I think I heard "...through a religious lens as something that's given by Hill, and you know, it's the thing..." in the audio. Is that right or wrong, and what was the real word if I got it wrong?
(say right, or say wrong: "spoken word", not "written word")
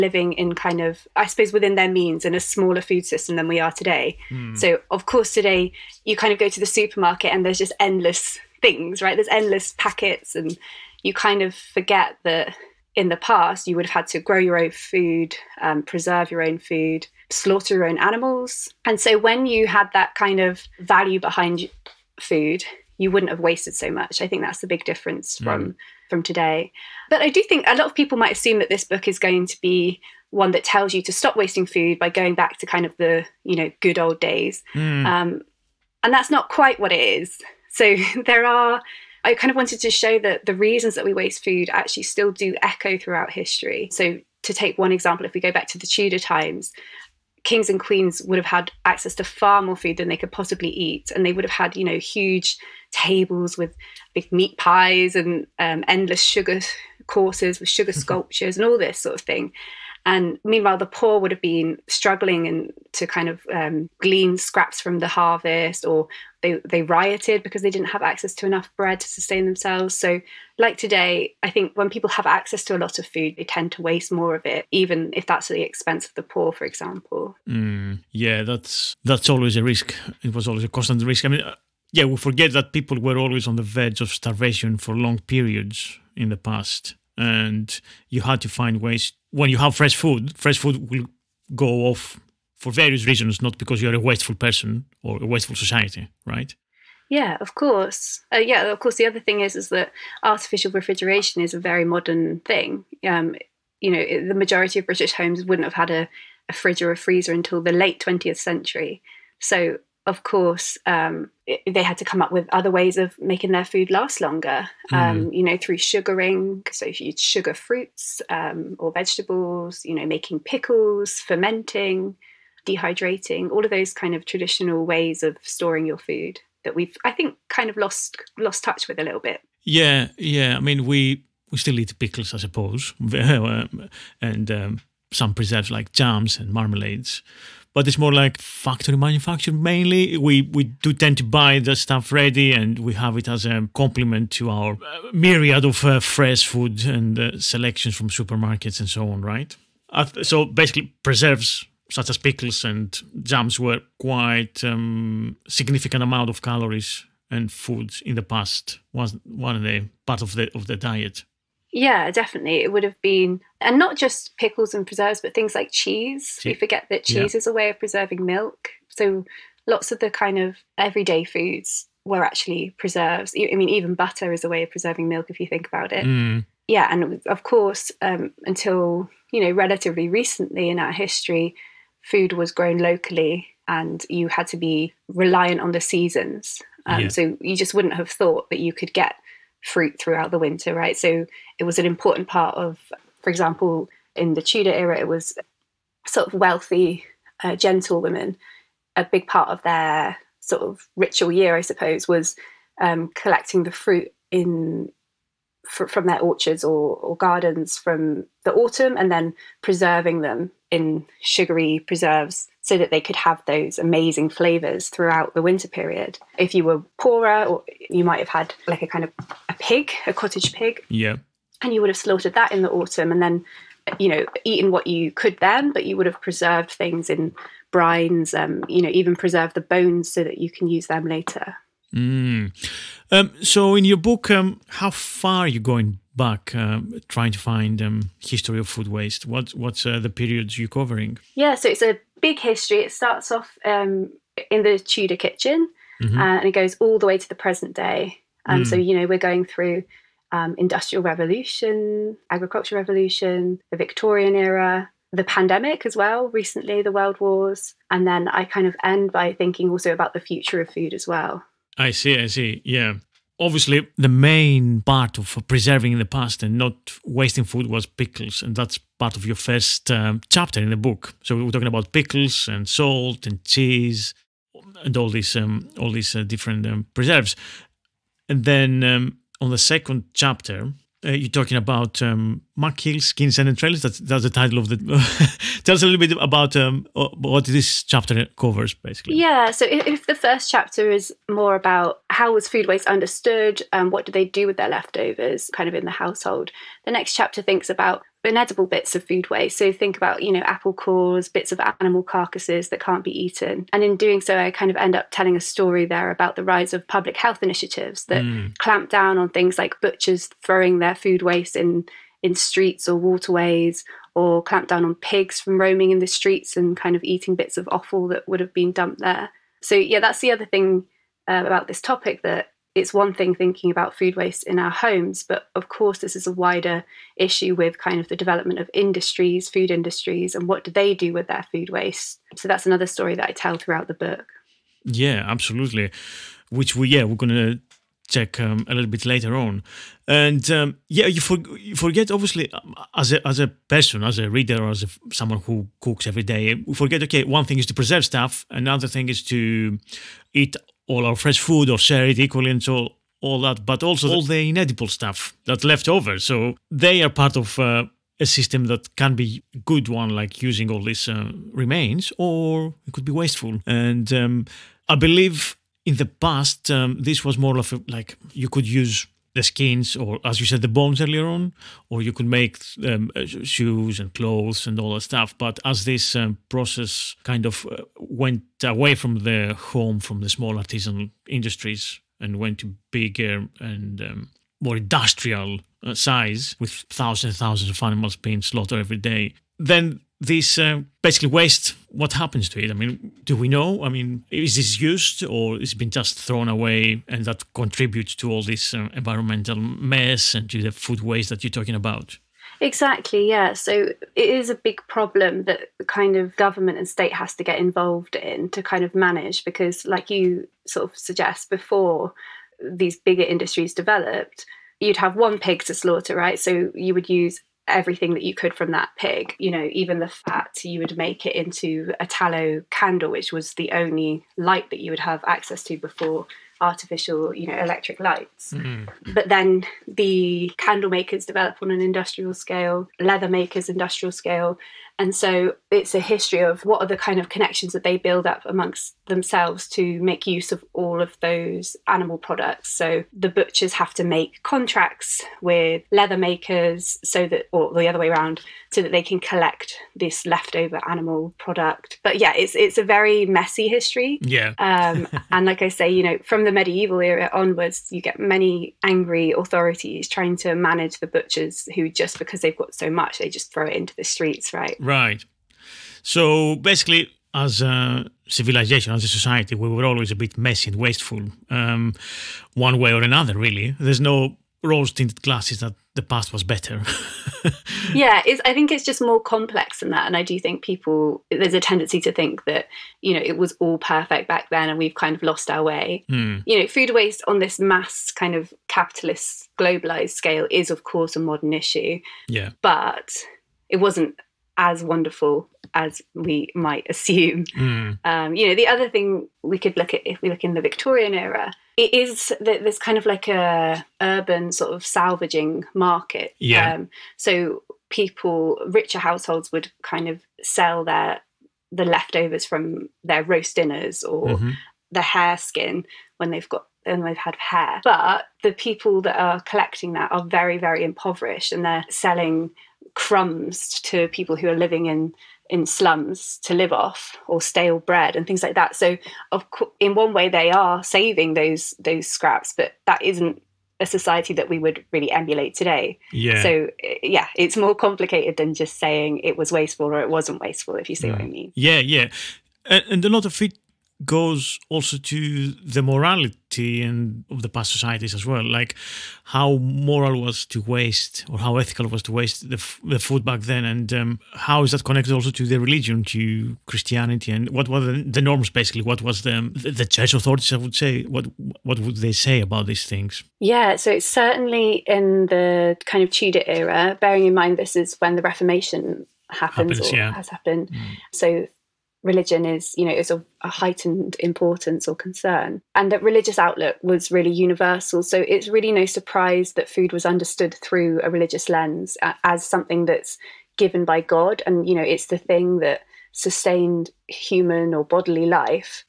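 wrong: "God", not "Hill".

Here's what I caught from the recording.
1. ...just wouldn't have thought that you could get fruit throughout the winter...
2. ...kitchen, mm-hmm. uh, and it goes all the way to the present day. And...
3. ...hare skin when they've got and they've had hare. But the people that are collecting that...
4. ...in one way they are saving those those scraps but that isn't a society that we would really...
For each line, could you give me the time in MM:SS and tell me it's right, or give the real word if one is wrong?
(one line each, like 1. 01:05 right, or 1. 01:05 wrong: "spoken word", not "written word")
1. 03:07 right
2. 04:05 right
3. 08:35 right
4. 08:49 right.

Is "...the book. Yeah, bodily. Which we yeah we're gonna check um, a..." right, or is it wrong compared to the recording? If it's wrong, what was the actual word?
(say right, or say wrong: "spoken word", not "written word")
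wrong: "absolutely", not "bodily".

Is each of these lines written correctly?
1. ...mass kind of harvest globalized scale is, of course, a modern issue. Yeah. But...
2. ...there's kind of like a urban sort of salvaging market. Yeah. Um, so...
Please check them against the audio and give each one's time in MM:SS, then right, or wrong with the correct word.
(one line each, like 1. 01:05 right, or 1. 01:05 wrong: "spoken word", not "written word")
1. 08:07 wrong: "capitalist", not "harvest"
2. 08:22 right.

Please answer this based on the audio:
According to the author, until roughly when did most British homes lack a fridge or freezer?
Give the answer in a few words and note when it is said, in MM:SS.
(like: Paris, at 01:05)
late 20th century, at 01:47.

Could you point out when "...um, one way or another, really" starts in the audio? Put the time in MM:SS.
07:51.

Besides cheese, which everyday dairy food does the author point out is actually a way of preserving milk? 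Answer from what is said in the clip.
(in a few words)
butter.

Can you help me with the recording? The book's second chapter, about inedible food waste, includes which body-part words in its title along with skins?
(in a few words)
Entrails.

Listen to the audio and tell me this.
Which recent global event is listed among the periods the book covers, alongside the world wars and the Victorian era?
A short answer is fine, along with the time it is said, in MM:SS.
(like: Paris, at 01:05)
the pandemic, at 04:15.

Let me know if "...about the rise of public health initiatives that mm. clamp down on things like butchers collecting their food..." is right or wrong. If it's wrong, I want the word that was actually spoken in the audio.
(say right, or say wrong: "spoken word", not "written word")
wrong: "throwing", not "collecting".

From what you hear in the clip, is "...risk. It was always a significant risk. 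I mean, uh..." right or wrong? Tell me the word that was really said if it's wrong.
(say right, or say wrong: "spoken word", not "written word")
wrong: "constant", not "significant".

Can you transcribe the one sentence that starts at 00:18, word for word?
And so when you had that kind of value behind food, you wouldn't have wasted so much.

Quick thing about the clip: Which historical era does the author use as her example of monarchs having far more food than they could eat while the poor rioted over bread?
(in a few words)
Tudor times.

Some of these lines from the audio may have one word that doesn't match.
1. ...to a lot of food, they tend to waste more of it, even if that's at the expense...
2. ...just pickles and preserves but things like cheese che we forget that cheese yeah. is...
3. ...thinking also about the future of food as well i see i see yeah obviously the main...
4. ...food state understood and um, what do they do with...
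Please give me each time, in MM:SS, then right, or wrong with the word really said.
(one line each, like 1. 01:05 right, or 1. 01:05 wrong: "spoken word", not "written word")
1. 01:12 right
2. 02:43 right
3. 04:19 right
4. 04:52 wrong: "waste", not "state".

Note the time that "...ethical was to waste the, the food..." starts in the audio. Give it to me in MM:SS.
09:11.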